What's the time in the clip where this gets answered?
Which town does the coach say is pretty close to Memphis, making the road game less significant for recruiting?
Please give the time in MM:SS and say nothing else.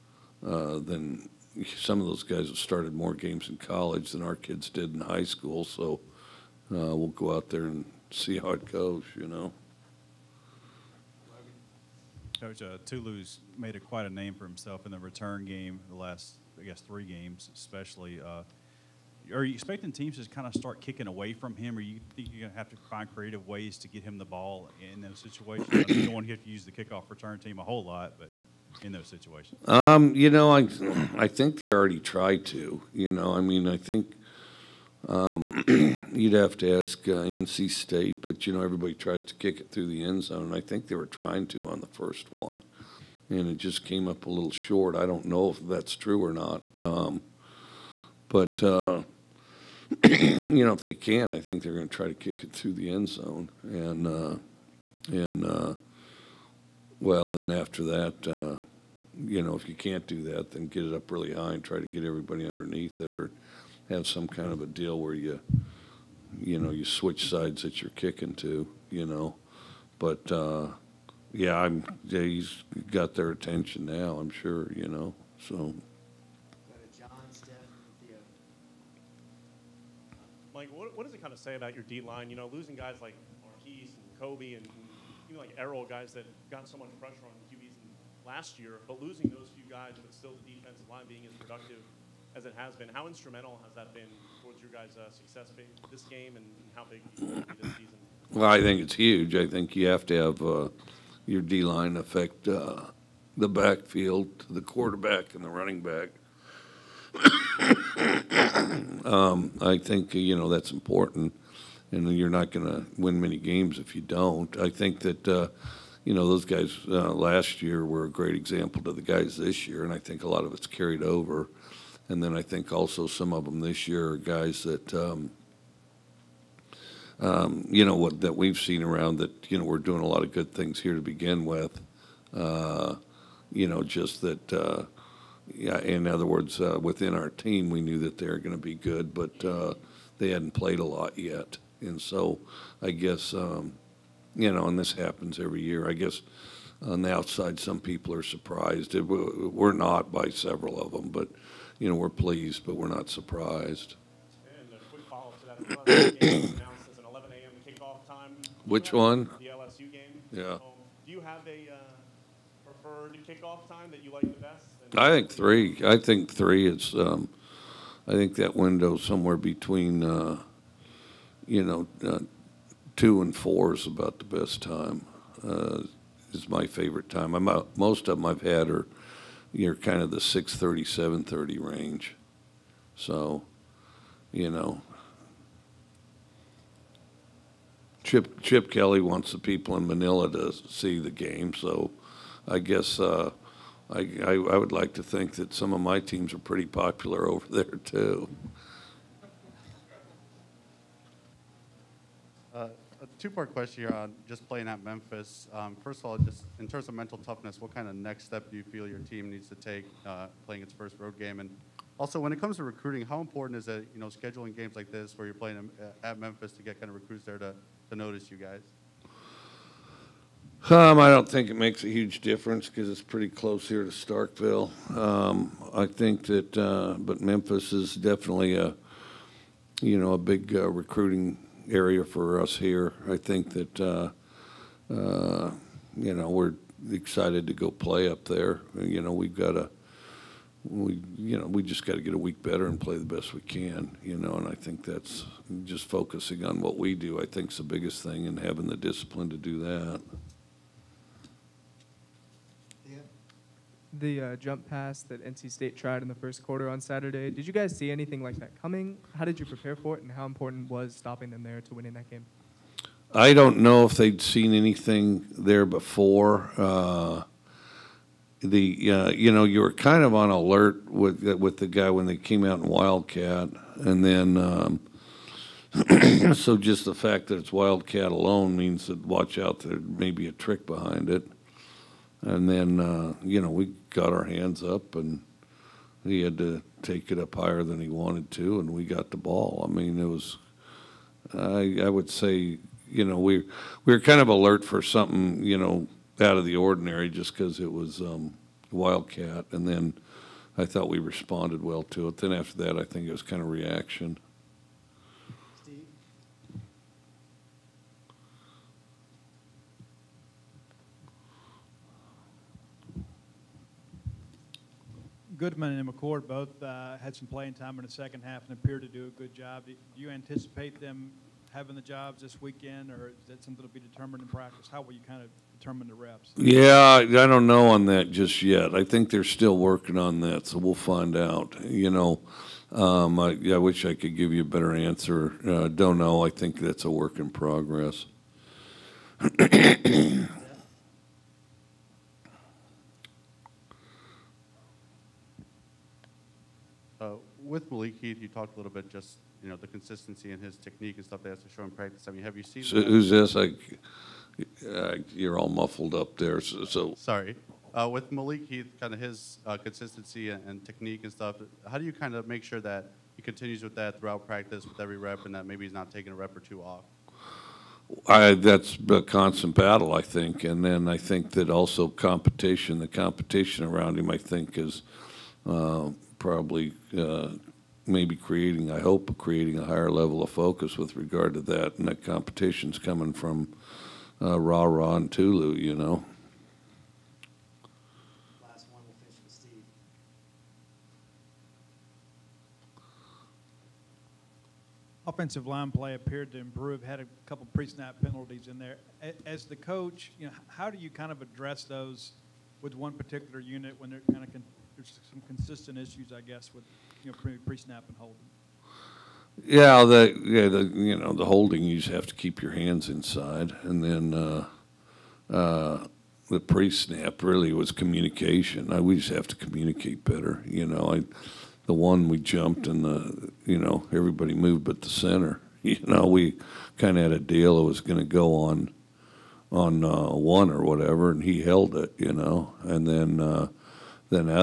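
03:43.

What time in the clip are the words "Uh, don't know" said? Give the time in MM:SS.
05:35.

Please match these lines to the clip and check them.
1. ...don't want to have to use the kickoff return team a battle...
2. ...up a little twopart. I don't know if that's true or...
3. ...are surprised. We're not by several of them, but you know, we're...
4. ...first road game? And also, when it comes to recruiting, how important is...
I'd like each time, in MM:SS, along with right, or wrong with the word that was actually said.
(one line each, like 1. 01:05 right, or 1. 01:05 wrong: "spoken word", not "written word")
1. 00:26 wrong: "whole", not "battle"
2. 00:44 wrong: "short", not "twopart"
3. 02:28 right
4. 03:30 right.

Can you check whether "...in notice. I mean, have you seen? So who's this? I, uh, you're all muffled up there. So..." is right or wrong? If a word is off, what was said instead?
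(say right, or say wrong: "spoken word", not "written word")
wrong: "practice", not "notice".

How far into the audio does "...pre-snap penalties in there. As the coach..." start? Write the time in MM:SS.
06:37.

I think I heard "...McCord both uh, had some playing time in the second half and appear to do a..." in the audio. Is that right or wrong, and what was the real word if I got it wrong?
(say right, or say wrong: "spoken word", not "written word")
right.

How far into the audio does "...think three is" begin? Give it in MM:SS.
02:45.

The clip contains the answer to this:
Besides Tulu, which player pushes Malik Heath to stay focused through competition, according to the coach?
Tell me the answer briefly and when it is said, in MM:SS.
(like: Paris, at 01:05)
Raw, at 06:24.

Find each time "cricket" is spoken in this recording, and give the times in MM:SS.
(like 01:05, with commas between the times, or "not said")
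not said.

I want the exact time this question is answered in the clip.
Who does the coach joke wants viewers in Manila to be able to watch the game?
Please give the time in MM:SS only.
03:08.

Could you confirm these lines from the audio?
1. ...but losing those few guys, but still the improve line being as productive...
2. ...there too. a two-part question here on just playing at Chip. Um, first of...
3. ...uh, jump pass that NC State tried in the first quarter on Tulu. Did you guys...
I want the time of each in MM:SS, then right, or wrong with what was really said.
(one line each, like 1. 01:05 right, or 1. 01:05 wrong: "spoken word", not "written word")
1. 01:28 wrong: "defensive", not "improve"
2. 03:17 wrong: "Memphis", not "Chip"
3. 04:14 wrong: "Saturday", not "Tulu".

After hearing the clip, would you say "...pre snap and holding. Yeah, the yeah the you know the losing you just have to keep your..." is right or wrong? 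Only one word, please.
wrong.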